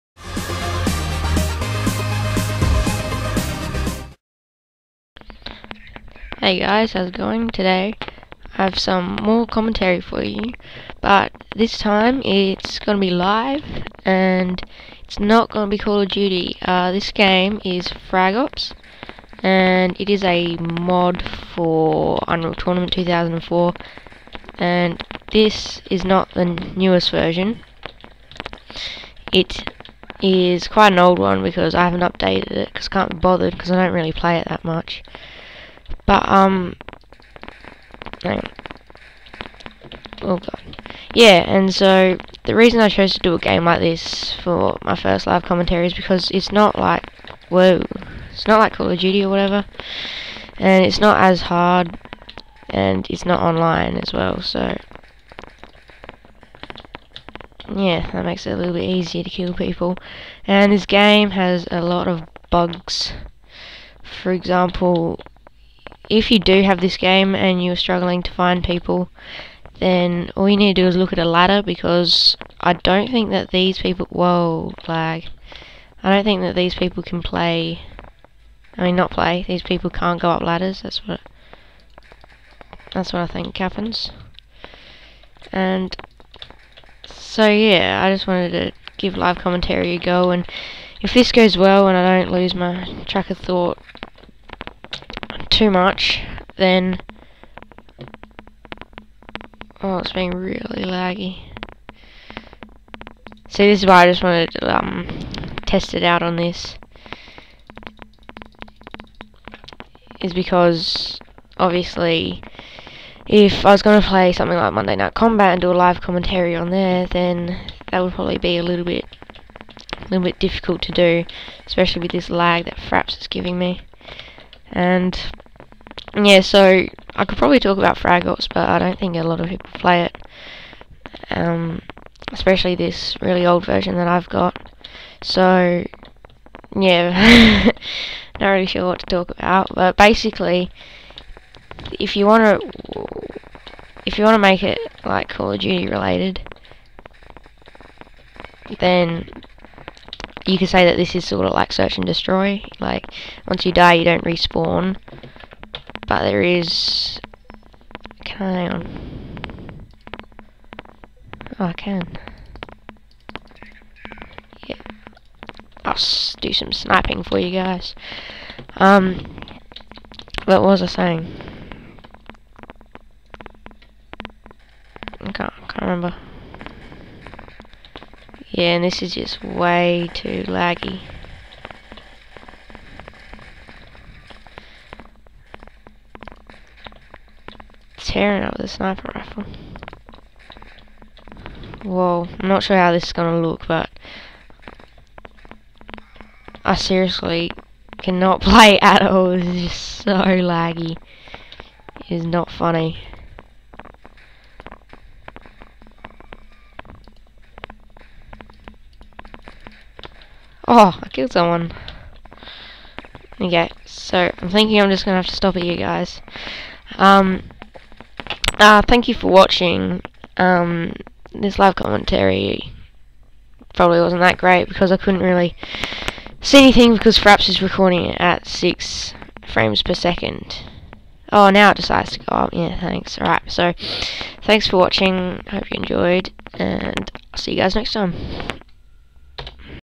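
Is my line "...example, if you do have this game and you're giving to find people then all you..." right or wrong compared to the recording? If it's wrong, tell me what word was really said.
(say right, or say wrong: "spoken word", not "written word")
wrong: "struggling", not "giving".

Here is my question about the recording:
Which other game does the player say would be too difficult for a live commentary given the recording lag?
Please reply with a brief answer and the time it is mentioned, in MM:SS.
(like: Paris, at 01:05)
Monday Night Combat, at 01:54.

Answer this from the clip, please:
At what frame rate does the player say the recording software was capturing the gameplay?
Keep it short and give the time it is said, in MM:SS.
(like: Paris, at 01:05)
6 frames per second, at 03:48.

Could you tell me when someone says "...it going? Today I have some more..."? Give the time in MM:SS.
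00:07.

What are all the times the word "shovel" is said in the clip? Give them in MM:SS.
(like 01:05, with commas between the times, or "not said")
not said.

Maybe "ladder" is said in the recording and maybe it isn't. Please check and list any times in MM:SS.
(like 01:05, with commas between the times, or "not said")
01:11, 01:20.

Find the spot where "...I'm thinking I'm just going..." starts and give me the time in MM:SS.
03:34.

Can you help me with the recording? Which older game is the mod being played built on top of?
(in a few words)
Unreal Tournament 2004.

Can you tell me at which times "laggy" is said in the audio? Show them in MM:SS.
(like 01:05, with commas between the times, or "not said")
01:40, 03:00, 03:20.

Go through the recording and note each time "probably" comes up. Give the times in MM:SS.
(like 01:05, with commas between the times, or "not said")
01:58, 02:07, 03:43.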